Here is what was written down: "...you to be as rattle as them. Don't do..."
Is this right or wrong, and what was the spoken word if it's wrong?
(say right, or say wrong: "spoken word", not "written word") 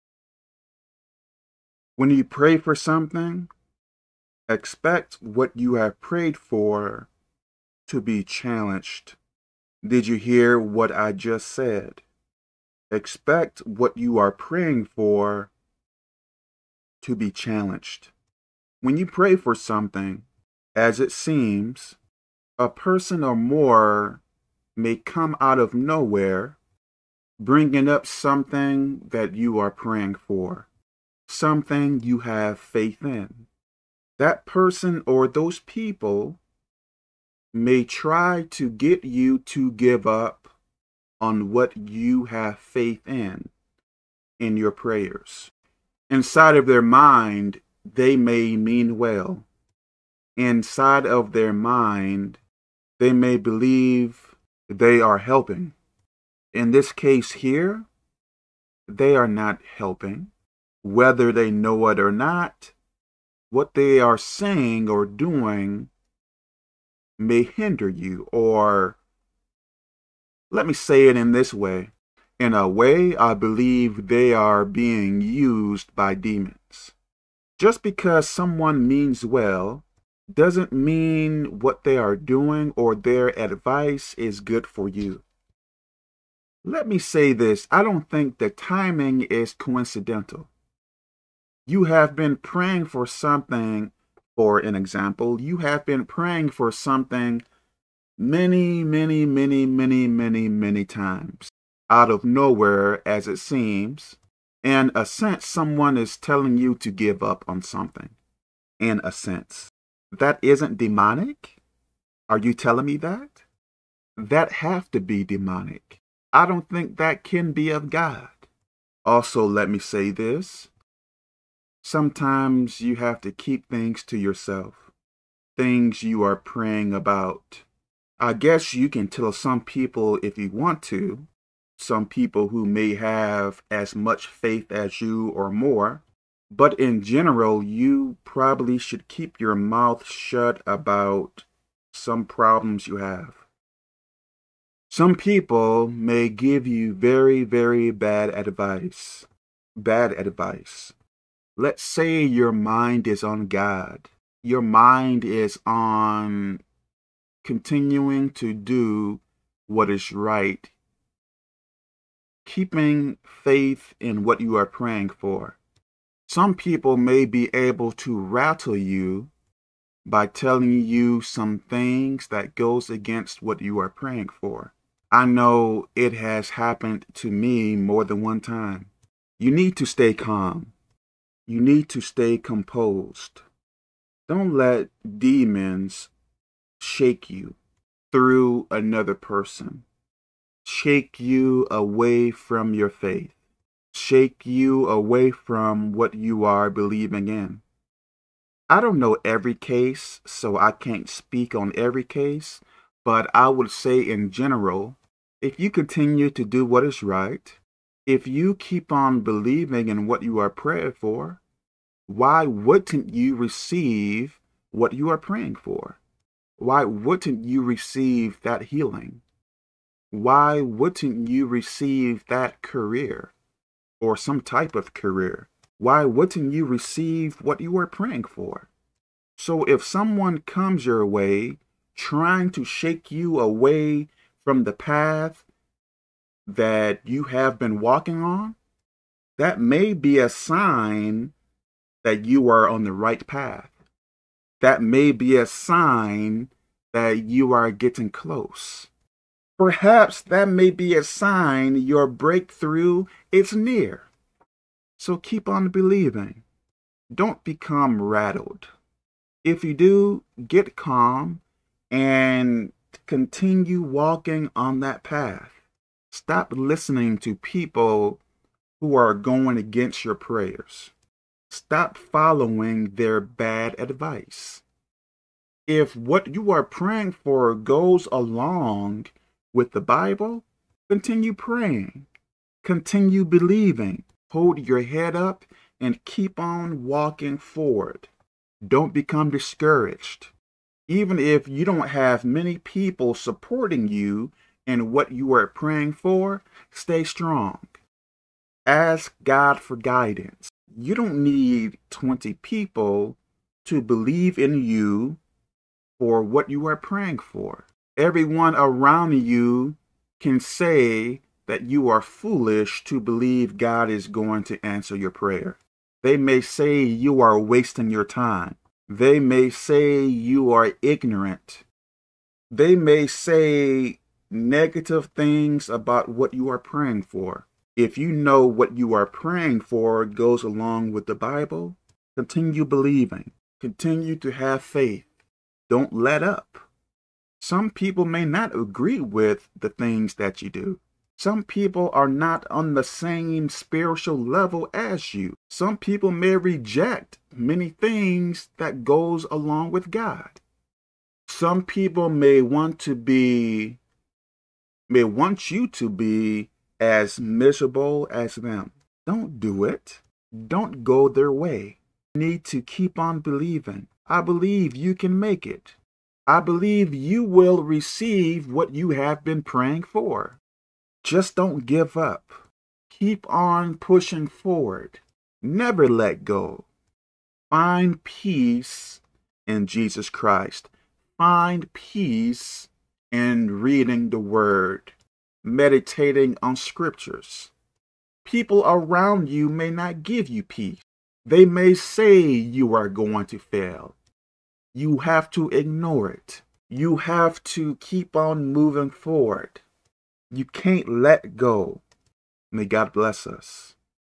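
wrong: "miserable", not "rattle".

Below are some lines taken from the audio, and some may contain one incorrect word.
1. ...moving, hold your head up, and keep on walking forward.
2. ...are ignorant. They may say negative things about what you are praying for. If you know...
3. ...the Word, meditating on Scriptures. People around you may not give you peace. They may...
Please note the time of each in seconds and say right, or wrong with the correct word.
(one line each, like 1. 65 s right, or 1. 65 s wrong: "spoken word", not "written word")
1. 283 s wrong: "believing", not "moving"
2. 320 s right
3. 384 s right.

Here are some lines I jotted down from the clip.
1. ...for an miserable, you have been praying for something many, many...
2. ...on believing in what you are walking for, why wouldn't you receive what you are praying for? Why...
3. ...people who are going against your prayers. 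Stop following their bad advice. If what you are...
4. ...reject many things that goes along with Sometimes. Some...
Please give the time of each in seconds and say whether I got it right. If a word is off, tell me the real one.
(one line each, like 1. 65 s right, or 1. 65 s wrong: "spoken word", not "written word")
1. 94 s wrong: "example", not "miserable"
2. 208 s wrong: "praying", not "walking"
3. 267 s right
4. 346 s wrong: "God", not "Sometimes".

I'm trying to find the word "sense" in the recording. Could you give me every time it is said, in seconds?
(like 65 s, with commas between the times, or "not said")
105 s, 109 s.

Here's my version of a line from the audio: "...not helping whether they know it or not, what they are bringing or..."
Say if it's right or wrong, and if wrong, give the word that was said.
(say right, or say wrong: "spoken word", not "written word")
wrong: "saying", not "bringing".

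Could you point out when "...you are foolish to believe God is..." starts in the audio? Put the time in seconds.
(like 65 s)
311 s.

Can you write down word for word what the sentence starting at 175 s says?
I know it has happened to me more than one time.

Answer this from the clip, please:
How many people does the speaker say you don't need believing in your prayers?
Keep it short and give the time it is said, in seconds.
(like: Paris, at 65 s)
20, at 301 s.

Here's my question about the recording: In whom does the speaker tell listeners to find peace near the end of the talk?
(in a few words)
Jesus Christ.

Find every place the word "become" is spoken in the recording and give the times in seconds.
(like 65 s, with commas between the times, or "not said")
257 s, 288 s.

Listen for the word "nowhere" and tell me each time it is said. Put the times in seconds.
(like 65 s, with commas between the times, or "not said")
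25 s, 102 s.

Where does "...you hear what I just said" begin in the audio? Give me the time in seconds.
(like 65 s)
10 s.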